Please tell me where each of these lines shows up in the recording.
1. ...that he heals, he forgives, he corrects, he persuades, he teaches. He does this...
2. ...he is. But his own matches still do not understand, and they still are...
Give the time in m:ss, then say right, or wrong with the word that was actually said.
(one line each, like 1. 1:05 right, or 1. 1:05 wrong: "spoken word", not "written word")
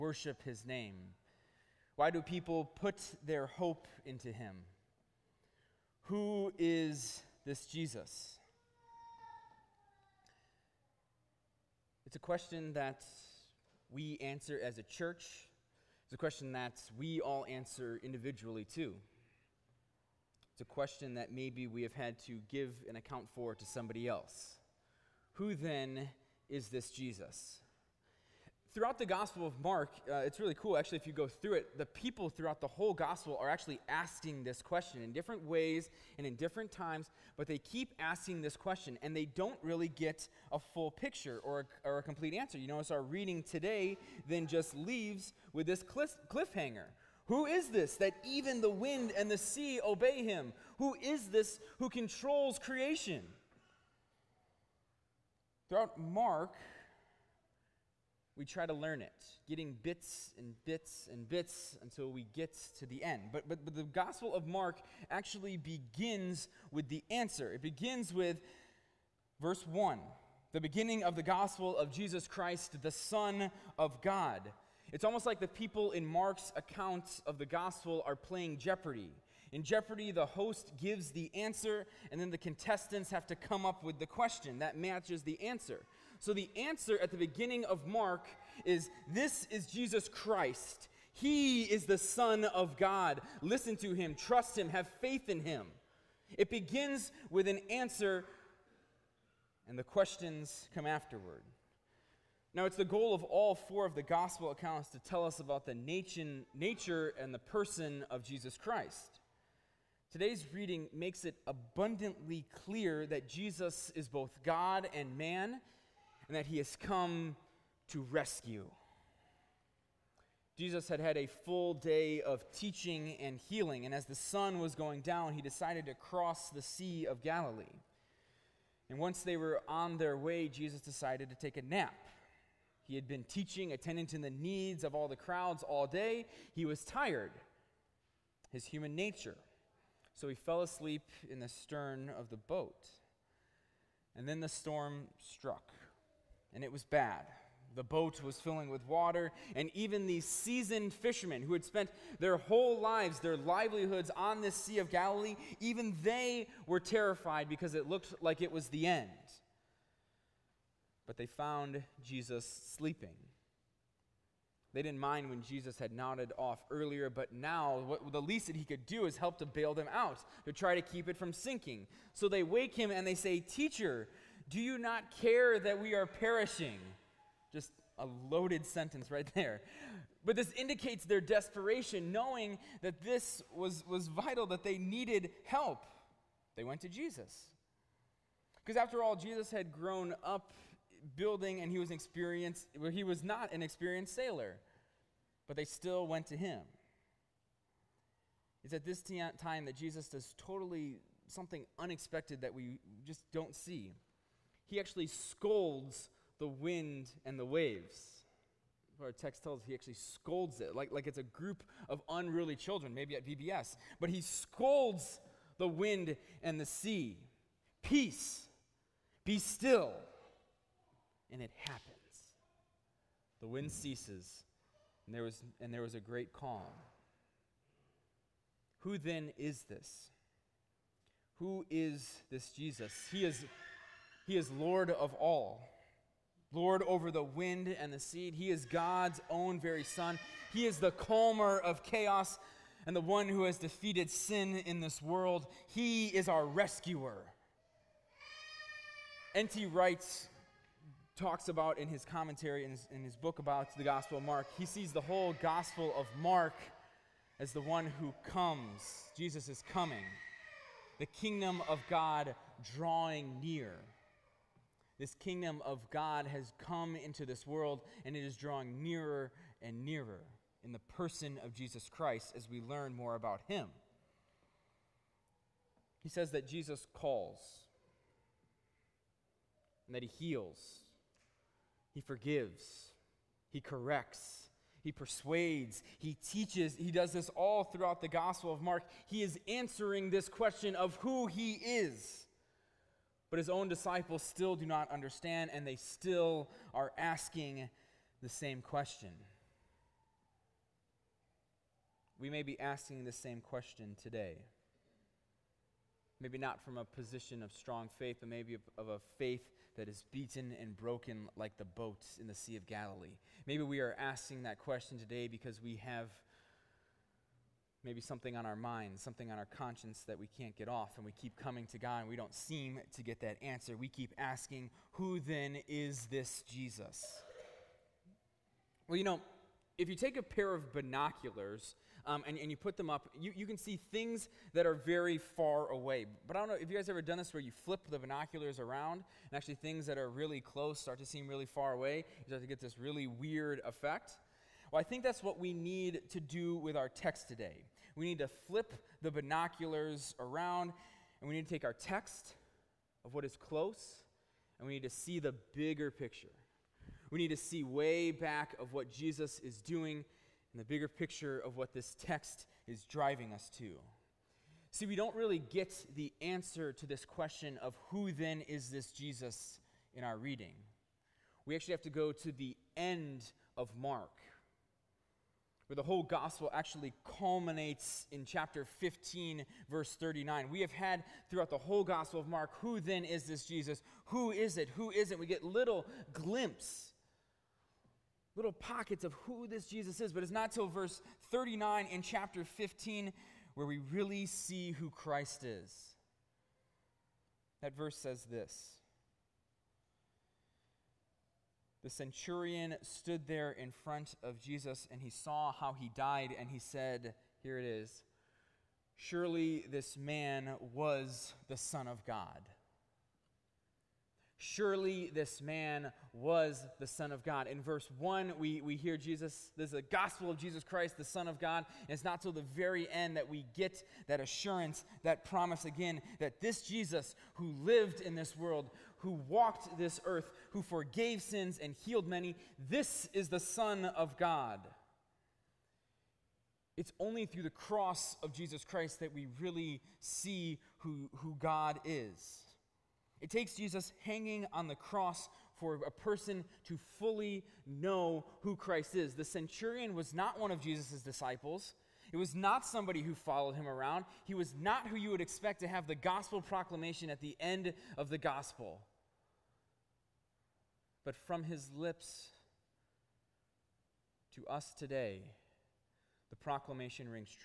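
1. 4:39 right
2. 4:51 wrong: "disciples", not "matches".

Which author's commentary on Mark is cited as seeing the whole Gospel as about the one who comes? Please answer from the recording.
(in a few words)
N.T. Wright.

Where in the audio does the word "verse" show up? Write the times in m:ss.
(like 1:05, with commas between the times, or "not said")
1:09, 6:19, 6:30, 6:37, 6:57.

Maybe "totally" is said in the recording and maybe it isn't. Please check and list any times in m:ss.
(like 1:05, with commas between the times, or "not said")
3:20.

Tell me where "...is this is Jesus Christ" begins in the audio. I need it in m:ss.
1:28.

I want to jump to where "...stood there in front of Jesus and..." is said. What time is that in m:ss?
6:42.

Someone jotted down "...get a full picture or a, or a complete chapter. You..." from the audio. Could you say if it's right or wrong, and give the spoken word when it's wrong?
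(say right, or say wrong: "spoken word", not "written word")
wrong: "answer", not "chapter".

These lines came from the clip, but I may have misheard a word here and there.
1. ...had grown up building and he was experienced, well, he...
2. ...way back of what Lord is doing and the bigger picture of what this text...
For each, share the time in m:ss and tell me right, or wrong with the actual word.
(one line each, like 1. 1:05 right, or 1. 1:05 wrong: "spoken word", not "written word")
1. 3:09 right
2. 5:57 wrong: "Jesus", not "Lord".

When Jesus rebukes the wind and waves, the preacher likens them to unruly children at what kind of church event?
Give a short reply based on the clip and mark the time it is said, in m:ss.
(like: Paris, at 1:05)
VBS, at 3:33.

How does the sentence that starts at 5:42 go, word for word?
You start to get this really weird effect.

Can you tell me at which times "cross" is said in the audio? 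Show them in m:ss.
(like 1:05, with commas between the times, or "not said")
2:05, 7:17, 7:24.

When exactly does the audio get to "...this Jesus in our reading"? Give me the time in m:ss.
6:08.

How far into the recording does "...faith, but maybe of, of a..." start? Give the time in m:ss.
5:07.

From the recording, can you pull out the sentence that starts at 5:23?
We keep asking, Who then is this Jesus?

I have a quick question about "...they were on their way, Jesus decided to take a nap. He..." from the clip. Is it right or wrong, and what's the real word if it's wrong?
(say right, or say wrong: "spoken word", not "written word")
right.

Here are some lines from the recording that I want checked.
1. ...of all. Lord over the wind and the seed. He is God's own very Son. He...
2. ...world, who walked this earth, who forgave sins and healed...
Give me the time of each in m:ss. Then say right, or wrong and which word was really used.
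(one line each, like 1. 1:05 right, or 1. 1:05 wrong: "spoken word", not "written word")
1. 3:54 right
2. 7:08 right.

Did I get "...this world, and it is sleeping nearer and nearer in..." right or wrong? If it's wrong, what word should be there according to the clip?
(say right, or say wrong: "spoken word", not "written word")
wrong: "drawing", not "sleeping".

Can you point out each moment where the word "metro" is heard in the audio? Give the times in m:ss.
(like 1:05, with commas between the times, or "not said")
not said.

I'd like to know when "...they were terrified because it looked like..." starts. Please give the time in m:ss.
2:36.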